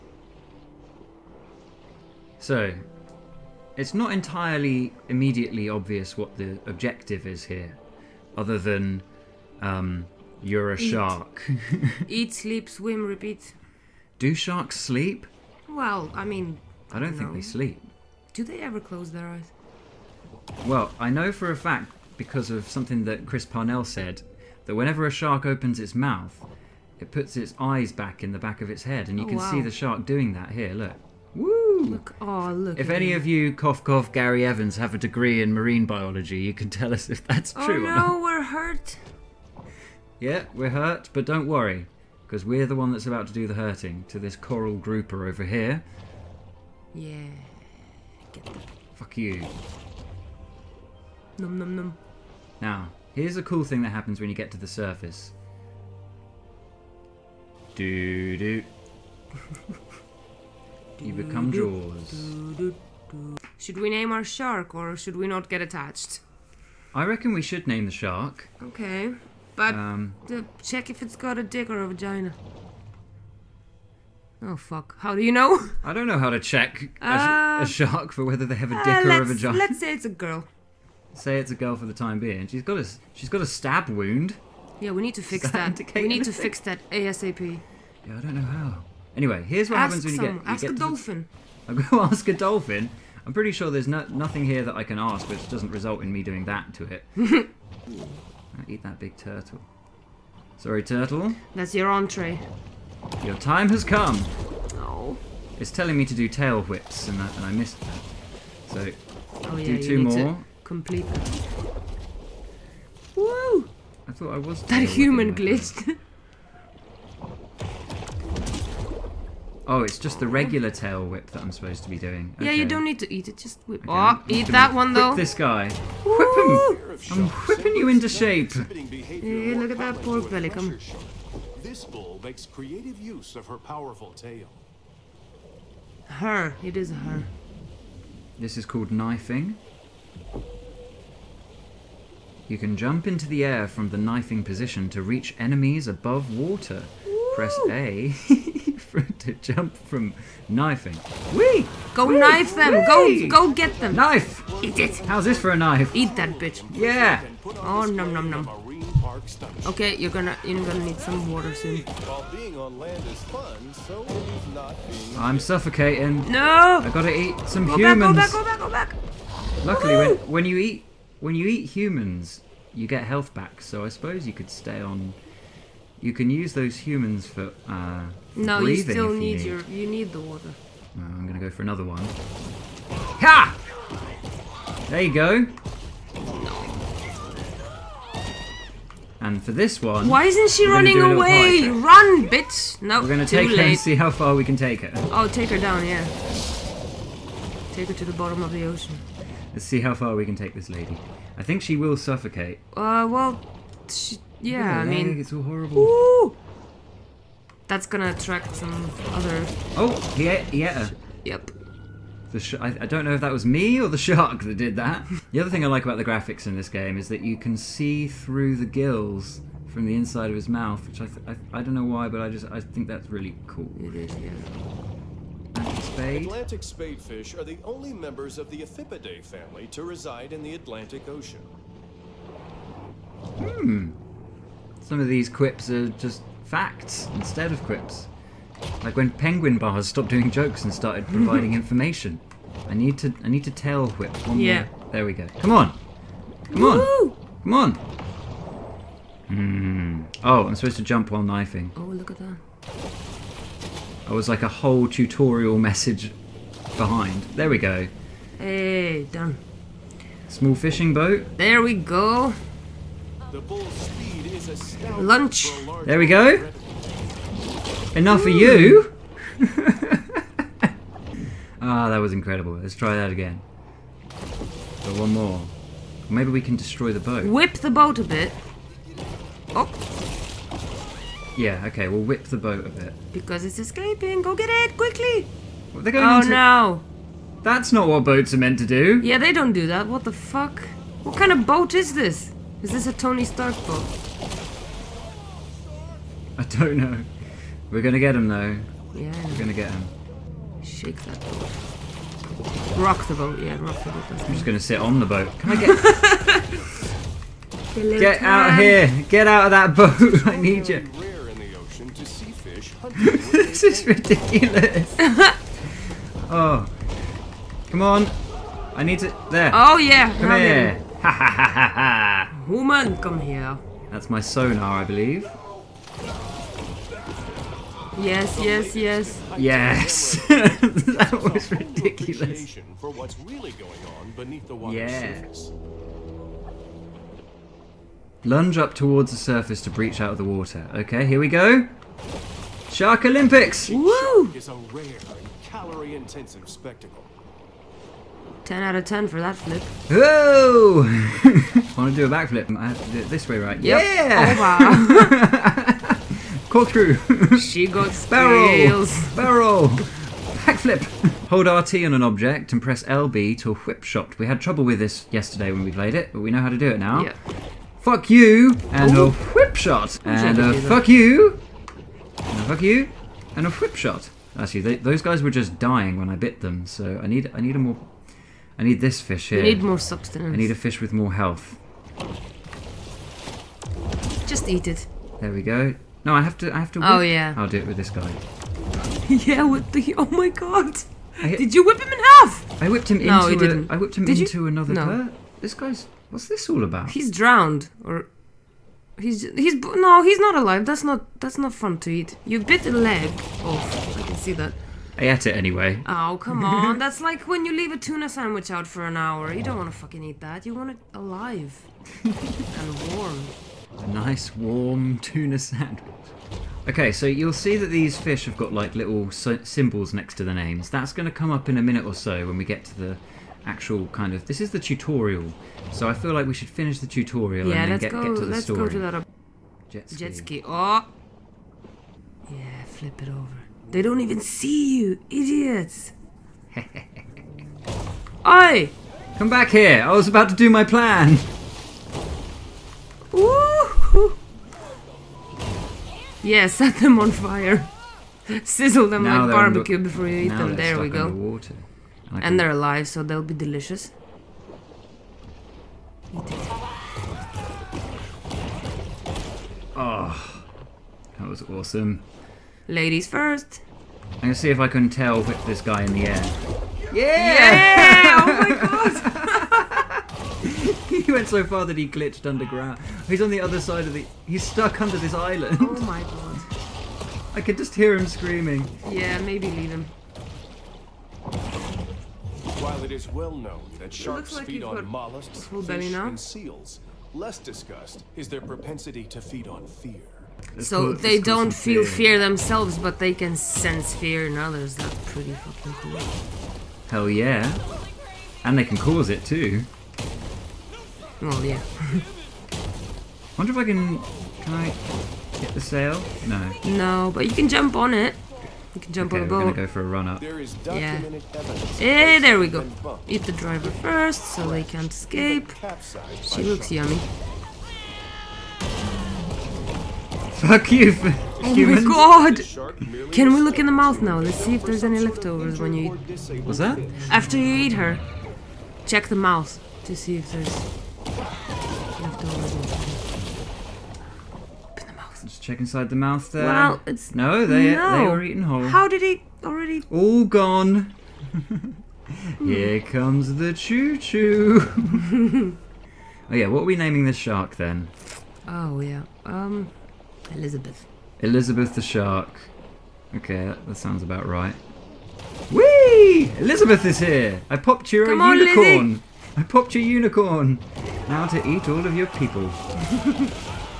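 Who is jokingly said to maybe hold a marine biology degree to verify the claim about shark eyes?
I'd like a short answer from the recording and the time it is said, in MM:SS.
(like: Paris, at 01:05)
Gary Evans, at 00:34.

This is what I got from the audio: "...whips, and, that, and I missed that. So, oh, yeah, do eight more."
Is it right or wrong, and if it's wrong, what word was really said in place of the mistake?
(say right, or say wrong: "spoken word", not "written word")
wrong: "two", not "eight".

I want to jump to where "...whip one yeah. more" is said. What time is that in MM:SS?
04:03.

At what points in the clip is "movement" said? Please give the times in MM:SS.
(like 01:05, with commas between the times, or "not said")
not said.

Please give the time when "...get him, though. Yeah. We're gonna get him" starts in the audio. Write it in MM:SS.
04:57.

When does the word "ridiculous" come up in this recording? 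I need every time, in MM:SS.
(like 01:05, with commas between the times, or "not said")
05:13, 05:31.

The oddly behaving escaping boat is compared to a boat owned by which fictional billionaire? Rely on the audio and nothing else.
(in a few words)
Tony Stark.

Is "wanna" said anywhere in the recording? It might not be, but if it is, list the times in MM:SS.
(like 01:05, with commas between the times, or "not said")
not said.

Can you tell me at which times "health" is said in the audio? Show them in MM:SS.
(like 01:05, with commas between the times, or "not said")
02:53, 06:21.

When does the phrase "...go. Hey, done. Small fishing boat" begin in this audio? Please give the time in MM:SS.
04:17.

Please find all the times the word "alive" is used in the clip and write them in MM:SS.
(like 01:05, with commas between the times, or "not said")
06:40, 06:50, 07:32.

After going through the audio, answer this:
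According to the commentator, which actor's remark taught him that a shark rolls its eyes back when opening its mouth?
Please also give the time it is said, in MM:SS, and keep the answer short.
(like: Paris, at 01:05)
Chris Parnell, at 00:23.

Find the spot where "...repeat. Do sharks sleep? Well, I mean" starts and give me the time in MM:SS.
00:13.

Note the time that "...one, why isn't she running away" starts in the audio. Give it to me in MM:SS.
03:09.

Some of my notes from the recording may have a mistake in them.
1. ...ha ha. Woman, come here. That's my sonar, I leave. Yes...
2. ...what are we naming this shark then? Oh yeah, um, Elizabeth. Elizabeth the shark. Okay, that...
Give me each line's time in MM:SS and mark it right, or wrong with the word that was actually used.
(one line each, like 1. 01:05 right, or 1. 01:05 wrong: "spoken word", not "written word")
1. 05:21 wrong: "believe", not "leave"
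2. 09:06 right.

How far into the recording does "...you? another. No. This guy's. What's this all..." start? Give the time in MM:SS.
06:34.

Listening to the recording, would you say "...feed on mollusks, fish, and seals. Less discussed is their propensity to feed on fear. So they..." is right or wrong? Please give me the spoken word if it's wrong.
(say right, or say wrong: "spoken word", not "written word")
right.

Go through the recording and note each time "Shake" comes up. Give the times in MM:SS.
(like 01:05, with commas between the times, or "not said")
05:00.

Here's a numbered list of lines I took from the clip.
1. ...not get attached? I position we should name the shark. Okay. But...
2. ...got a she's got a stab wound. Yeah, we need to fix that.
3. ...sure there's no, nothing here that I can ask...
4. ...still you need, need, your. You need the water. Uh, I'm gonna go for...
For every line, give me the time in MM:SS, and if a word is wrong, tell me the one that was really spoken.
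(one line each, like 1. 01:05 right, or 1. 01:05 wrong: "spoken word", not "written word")
1. 01:05 wrong: "reckon", not "position"
2. 01:22 right
3. 01:33 right
4. 02:58 right.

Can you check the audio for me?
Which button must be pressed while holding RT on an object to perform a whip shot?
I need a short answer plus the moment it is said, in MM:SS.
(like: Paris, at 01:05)
LB, at 06:02.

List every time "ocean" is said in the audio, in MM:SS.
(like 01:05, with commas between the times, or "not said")
03:18, 03:51.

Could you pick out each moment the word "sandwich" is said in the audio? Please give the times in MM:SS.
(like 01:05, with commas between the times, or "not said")
06:48, 06:55.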